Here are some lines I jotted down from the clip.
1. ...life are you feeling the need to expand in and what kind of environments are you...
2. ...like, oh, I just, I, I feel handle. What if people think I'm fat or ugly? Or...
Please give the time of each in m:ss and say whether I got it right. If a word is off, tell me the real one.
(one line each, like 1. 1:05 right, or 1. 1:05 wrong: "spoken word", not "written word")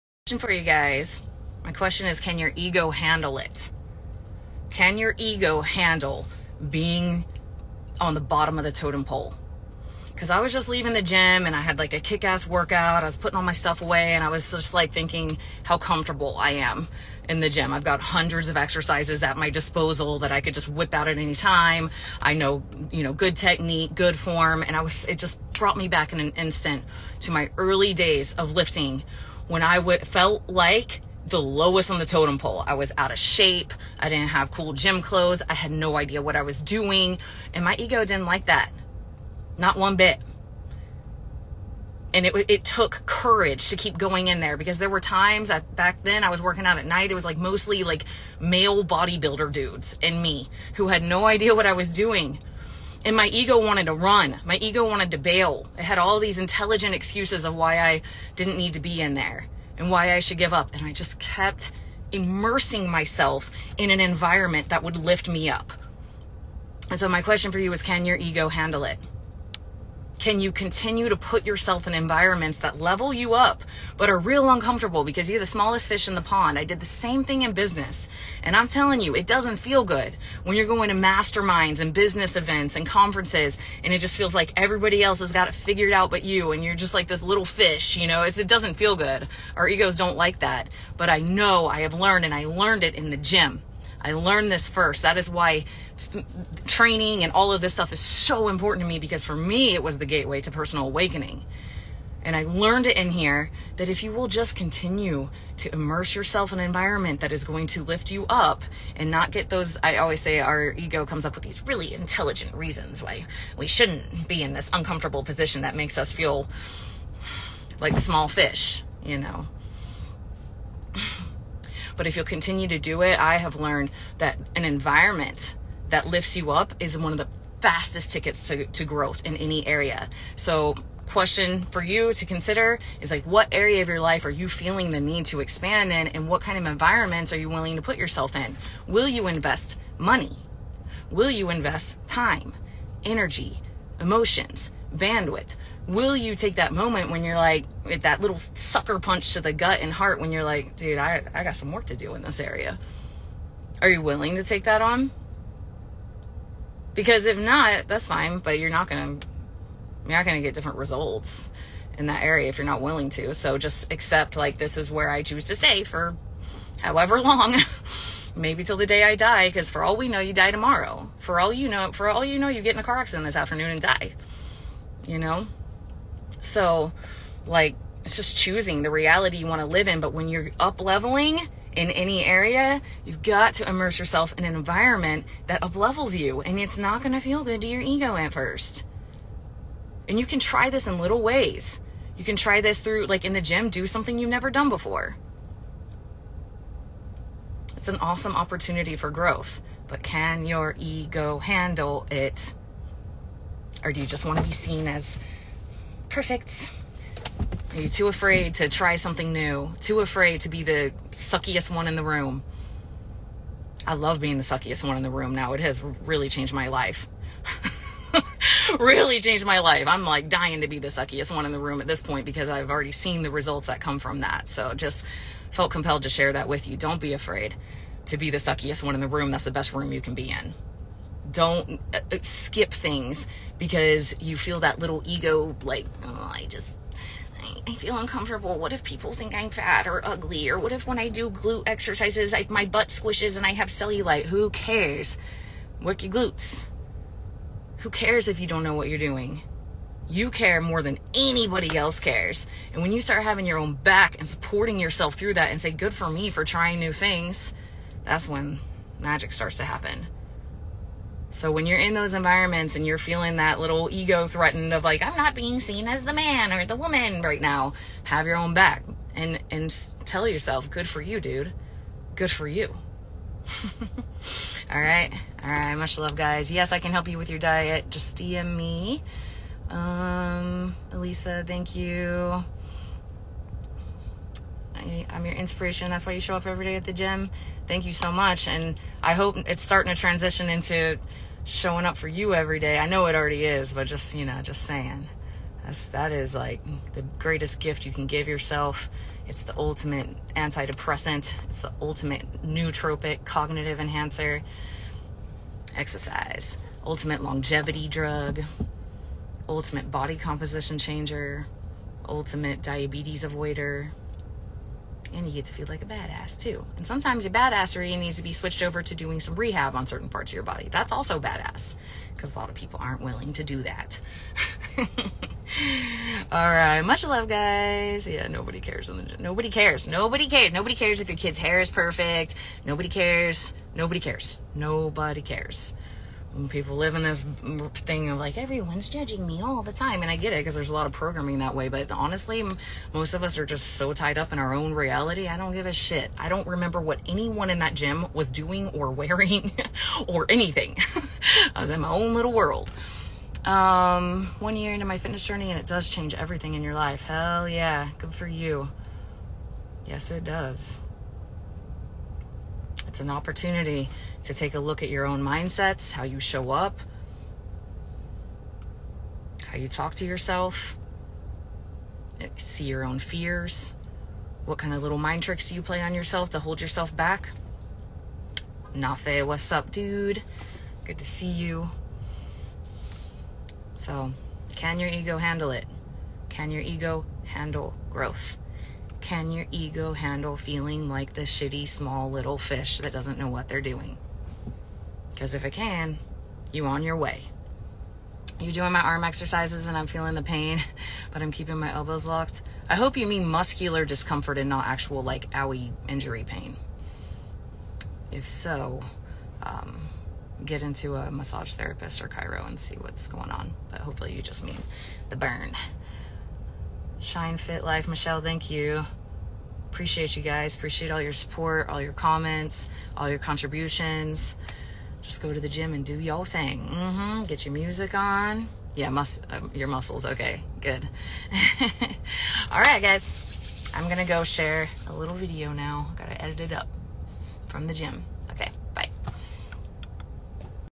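1. 2:13 right
2. 3:55 wrong: "uncomfortable", not "handle".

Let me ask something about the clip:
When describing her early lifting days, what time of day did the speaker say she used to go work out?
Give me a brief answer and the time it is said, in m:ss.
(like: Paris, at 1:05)
at night, at 0:46.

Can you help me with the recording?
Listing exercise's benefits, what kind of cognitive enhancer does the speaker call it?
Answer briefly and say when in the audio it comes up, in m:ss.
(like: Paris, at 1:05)
ultimate nootropic, at 5:01.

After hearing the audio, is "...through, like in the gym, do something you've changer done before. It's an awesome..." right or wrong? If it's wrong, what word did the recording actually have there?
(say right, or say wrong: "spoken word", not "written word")
wrong: "never", not "changer".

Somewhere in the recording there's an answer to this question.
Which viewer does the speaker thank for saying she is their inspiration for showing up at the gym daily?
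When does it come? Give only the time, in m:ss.
4:40.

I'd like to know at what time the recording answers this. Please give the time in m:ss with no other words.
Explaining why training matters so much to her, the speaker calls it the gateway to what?
1:40.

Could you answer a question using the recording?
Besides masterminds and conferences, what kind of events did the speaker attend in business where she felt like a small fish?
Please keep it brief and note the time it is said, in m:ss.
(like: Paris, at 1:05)
business events, at 1:21.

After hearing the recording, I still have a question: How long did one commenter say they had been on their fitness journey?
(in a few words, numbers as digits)
1 year.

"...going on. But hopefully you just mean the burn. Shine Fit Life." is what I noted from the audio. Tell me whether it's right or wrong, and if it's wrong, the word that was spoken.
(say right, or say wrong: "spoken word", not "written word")
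right.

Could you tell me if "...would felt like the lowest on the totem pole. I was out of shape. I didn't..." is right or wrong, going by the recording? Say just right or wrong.
right.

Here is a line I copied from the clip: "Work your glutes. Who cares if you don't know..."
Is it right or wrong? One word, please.
right.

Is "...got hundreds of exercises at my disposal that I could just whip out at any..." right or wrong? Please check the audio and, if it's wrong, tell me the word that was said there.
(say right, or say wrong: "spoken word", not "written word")
right.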